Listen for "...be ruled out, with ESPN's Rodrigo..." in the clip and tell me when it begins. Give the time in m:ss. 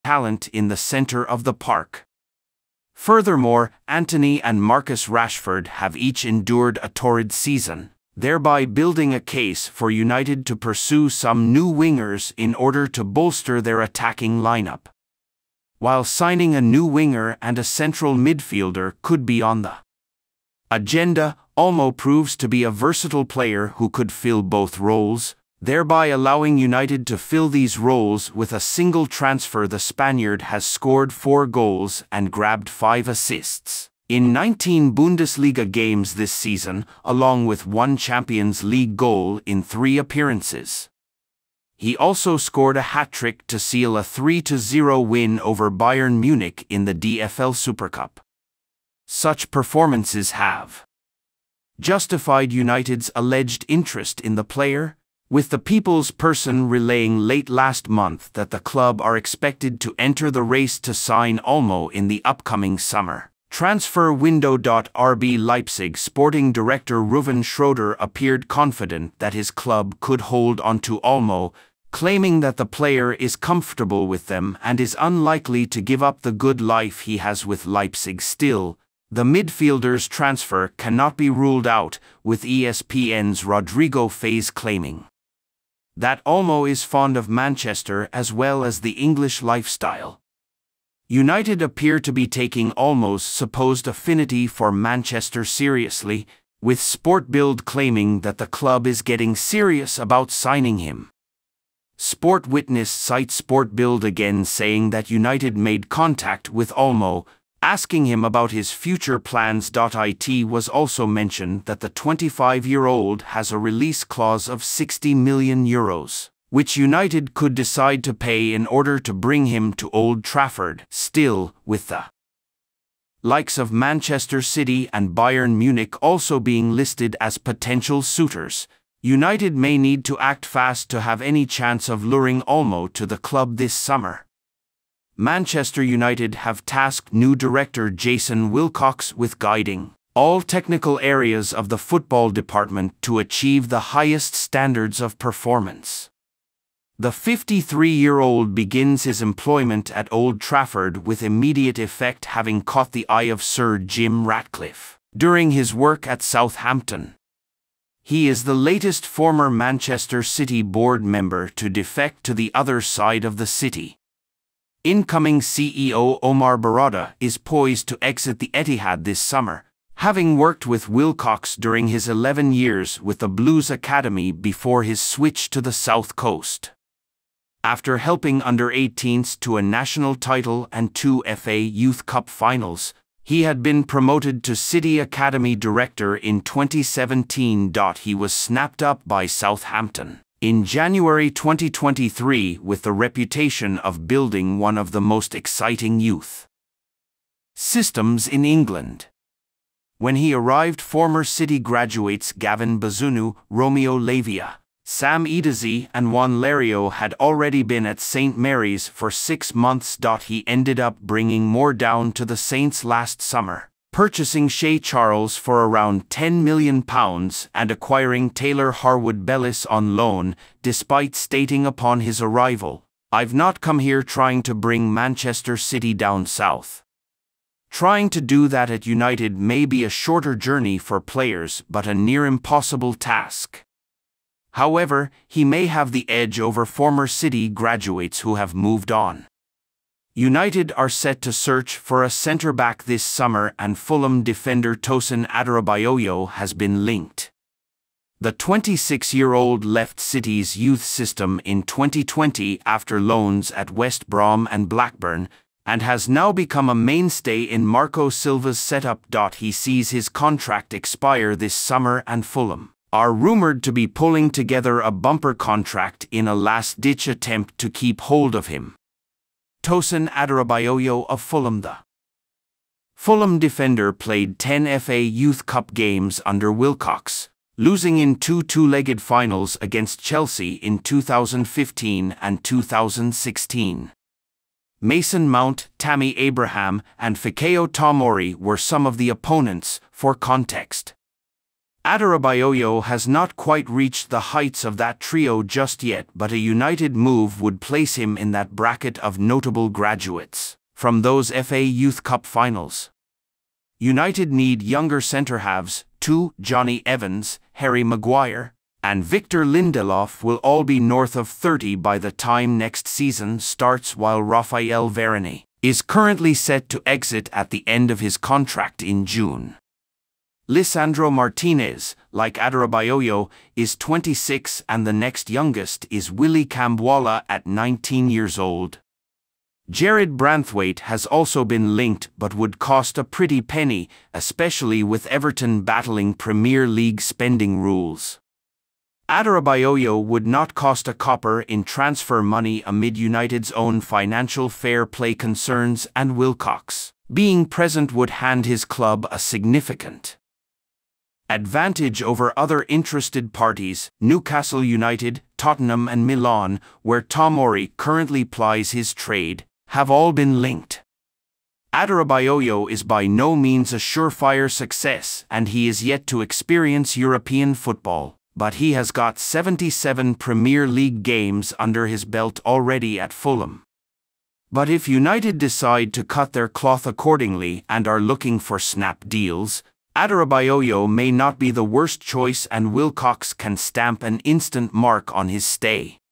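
1:21.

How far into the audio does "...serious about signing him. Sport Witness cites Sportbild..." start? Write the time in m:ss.
1:39.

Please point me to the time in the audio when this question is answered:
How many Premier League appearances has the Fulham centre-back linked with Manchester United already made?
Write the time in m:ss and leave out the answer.
6:09.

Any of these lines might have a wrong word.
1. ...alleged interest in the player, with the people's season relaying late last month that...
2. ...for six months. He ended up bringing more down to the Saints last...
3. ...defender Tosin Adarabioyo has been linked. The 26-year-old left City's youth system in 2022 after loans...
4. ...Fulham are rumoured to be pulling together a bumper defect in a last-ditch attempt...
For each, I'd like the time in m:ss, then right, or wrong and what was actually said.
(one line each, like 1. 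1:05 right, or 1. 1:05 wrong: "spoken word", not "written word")
1. 0:53 wrong: "person", not "season"
2. 3:28 right
3. 4:04 wrong: "2020", not "2022"
4. 4:22 wrong: "contract", not "defect".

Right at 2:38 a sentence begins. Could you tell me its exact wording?
He is the latest former Manchester City board member to defect to the other side of the city.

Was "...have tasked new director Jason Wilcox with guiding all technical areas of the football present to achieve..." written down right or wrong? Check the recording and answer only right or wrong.
wrong.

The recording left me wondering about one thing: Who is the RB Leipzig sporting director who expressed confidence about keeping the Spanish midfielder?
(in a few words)
Rouven Schroeder.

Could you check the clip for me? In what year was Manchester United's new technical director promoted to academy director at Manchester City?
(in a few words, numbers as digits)
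2017.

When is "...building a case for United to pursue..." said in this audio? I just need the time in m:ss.
0:08.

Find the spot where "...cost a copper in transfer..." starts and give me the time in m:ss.
5:40.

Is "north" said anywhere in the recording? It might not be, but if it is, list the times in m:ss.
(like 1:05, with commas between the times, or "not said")
5:10.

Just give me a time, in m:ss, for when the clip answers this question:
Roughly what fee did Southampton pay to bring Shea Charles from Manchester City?
3:36.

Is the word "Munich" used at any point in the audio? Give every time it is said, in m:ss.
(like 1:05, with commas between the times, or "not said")
0:46, 2:05.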